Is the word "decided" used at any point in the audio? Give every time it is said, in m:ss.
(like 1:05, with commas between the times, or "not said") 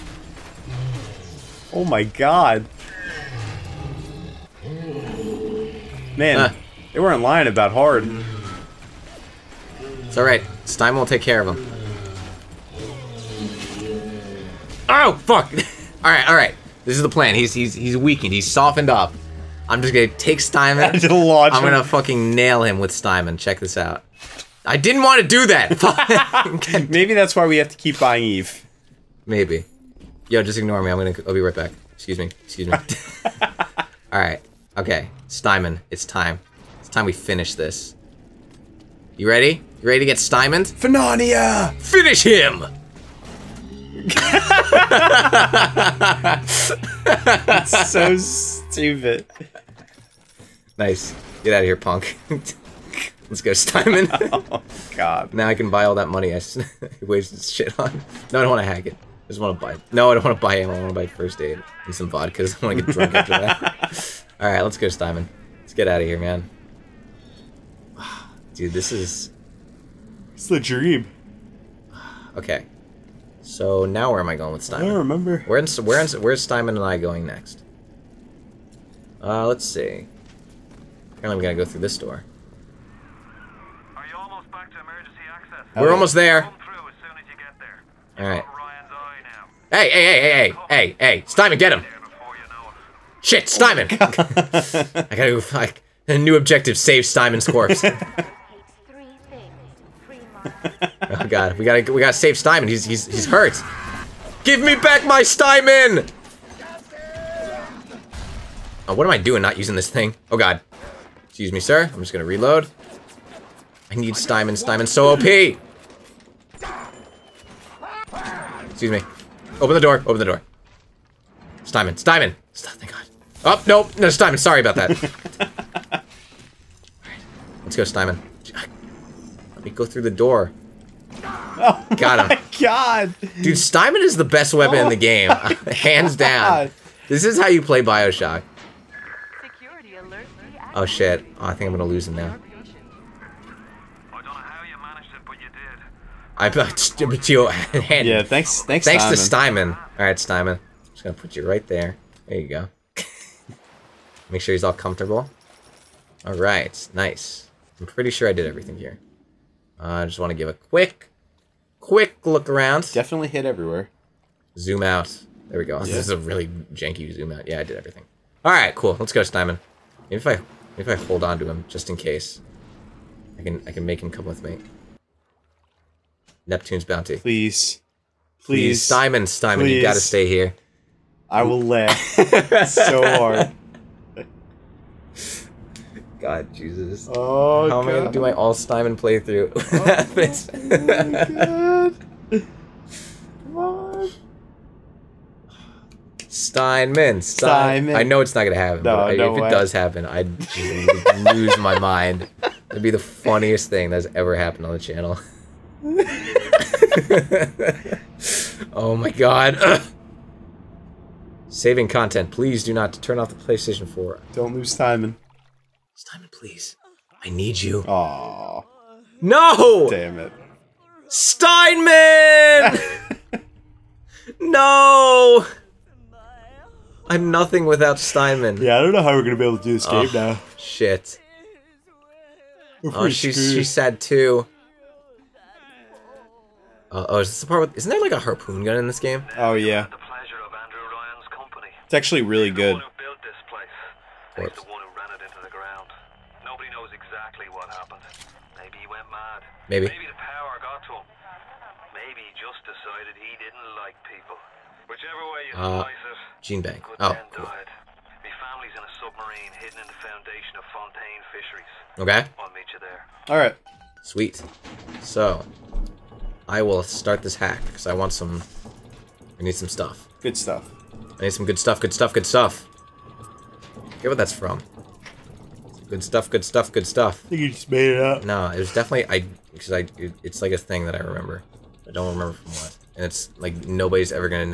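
4:12.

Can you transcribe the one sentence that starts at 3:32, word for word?
Please do not turn off the PlayStation 4.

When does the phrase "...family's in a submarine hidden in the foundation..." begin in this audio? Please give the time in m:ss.
4:18.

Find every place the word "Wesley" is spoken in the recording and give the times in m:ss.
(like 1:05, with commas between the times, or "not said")
not said.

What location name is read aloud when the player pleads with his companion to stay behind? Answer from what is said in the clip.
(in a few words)
Neptune's Bounty.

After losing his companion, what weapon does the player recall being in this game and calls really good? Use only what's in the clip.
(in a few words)
harpoon gun.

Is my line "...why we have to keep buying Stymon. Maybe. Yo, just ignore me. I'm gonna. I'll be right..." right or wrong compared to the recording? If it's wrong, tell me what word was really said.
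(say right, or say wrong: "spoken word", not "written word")
wrong: "Eve", not "Stymon".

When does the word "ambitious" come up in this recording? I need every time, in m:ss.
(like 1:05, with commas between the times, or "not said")
not said.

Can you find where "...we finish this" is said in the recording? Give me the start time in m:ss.
0:37.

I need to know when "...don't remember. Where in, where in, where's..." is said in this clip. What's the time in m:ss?
1:14.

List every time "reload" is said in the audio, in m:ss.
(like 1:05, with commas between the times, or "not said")
1:52.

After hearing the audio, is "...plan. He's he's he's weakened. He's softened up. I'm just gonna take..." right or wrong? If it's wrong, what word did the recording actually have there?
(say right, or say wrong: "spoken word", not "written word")
right.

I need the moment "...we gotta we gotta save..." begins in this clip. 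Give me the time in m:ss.
1:41.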